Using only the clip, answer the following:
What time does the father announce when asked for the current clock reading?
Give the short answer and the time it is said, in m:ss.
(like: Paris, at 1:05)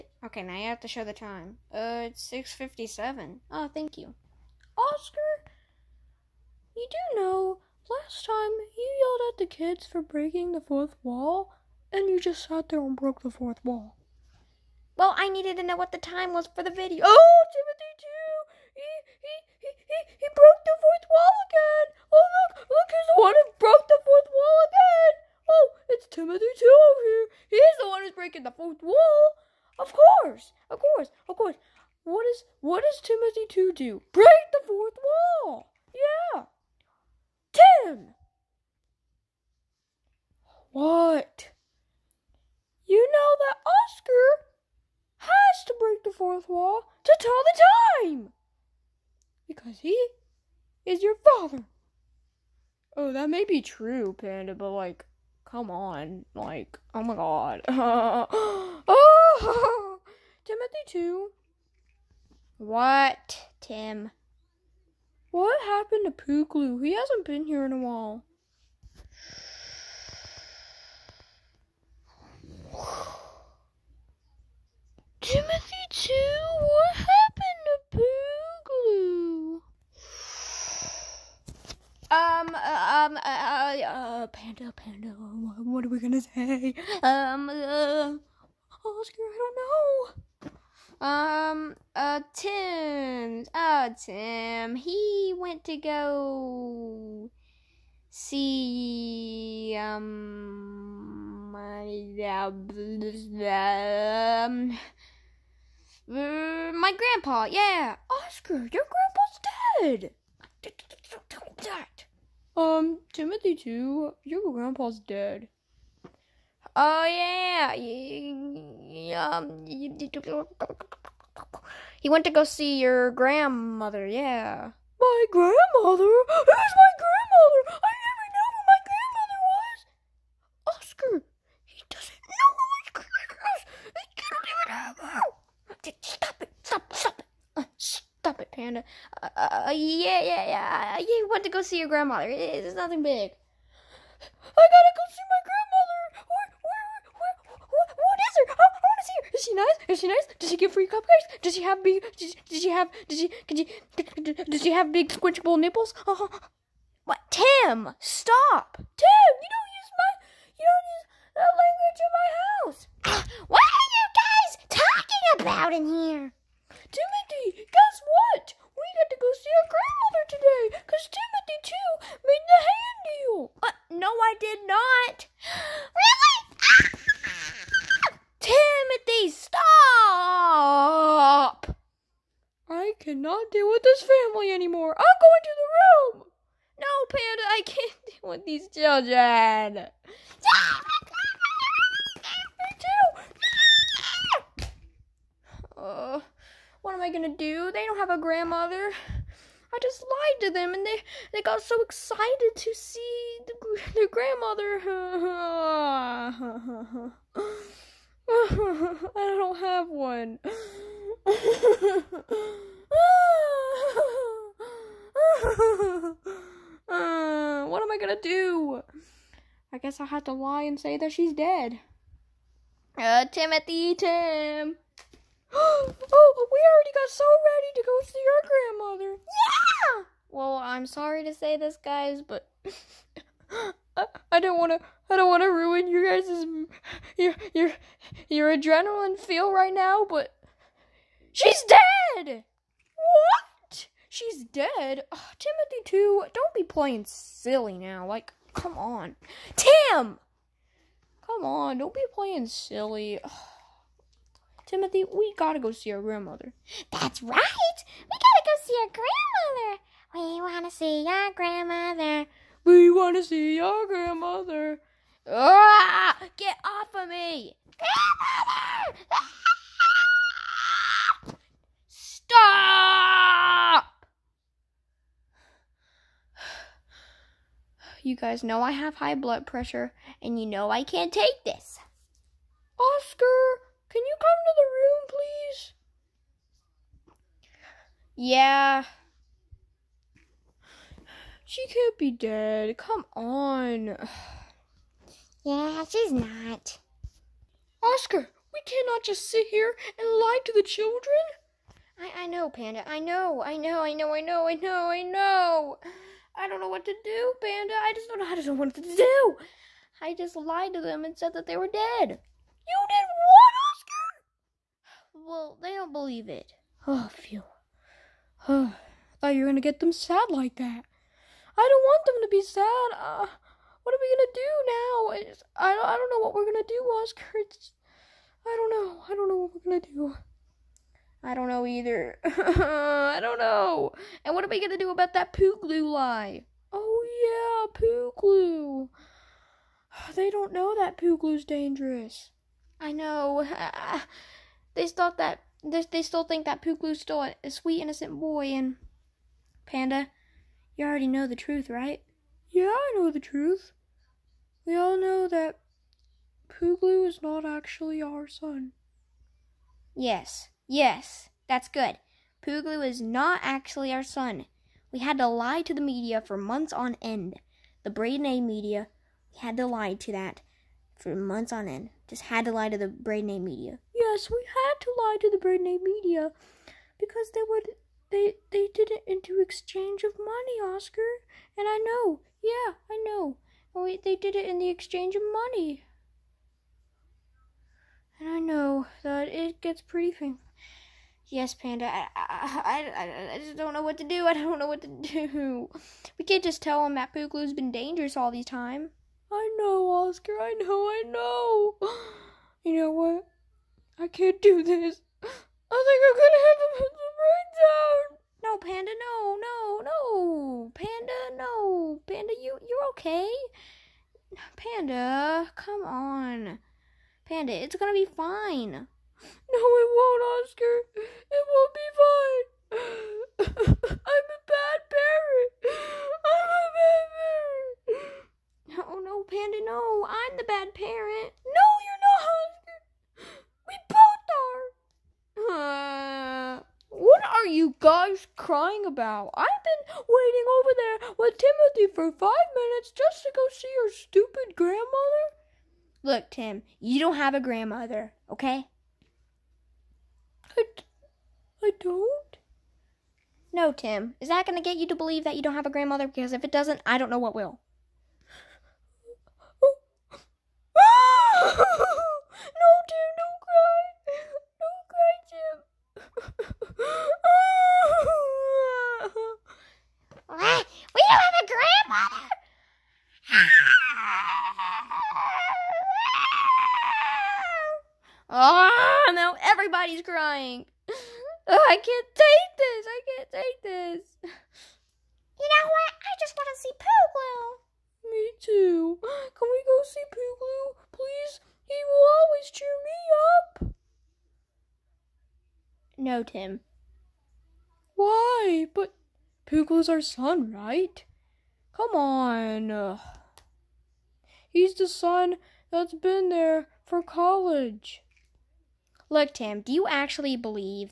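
6:57, at 0:02.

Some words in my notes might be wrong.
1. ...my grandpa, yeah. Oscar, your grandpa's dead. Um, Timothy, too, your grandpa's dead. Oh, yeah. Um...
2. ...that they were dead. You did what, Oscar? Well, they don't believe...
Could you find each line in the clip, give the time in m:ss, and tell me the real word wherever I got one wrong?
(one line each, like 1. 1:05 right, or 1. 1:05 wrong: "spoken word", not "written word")
1. 1:46 right
2. 5:11 right.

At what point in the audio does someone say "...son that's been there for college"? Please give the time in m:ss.
8:24.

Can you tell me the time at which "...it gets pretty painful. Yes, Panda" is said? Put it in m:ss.
6:29.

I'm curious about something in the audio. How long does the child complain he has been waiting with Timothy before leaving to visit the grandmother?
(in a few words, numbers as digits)
5 minutes.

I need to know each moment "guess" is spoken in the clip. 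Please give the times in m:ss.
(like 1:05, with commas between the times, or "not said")
2:47, 3:39.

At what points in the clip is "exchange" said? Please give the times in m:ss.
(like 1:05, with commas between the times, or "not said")
6:19, 6:24.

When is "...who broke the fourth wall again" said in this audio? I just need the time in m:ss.
0:23.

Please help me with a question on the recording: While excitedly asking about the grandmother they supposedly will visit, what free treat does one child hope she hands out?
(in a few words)
cupcakes.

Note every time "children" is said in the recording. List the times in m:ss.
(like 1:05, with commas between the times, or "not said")
3:08, 5:00.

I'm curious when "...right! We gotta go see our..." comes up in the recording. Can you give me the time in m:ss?
4:17.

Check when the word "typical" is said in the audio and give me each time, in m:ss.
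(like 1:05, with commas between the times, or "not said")
not said.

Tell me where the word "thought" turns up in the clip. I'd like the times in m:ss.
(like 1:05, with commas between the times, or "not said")
5:19, 5:44.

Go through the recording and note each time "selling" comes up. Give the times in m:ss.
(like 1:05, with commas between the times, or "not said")
not said.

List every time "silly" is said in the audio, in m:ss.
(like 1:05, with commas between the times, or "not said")
4:07, 4:12.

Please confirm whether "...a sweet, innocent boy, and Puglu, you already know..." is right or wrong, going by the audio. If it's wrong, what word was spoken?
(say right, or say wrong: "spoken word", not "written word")
wrong: "Panda", not "Puglu".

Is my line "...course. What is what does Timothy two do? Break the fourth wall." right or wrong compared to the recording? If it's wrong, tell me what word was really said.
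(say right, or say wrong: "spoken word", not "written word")
right.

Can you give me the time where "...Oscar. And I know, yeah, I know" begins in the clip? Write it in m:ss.
6:20.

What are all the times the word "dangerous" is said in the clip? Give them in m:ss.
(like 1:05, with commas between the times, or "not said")
5:41, 6:37.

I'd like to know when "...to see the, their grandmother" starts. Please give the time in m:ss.
3:22.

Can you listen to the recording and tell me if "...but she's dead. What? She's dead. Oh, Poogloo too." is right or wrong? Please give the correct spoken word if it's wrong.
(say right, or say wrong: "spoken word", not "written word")
wrong: "Timothy", not "Poogloo".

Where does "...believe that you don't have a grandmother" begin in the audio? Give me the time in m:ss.
7:34.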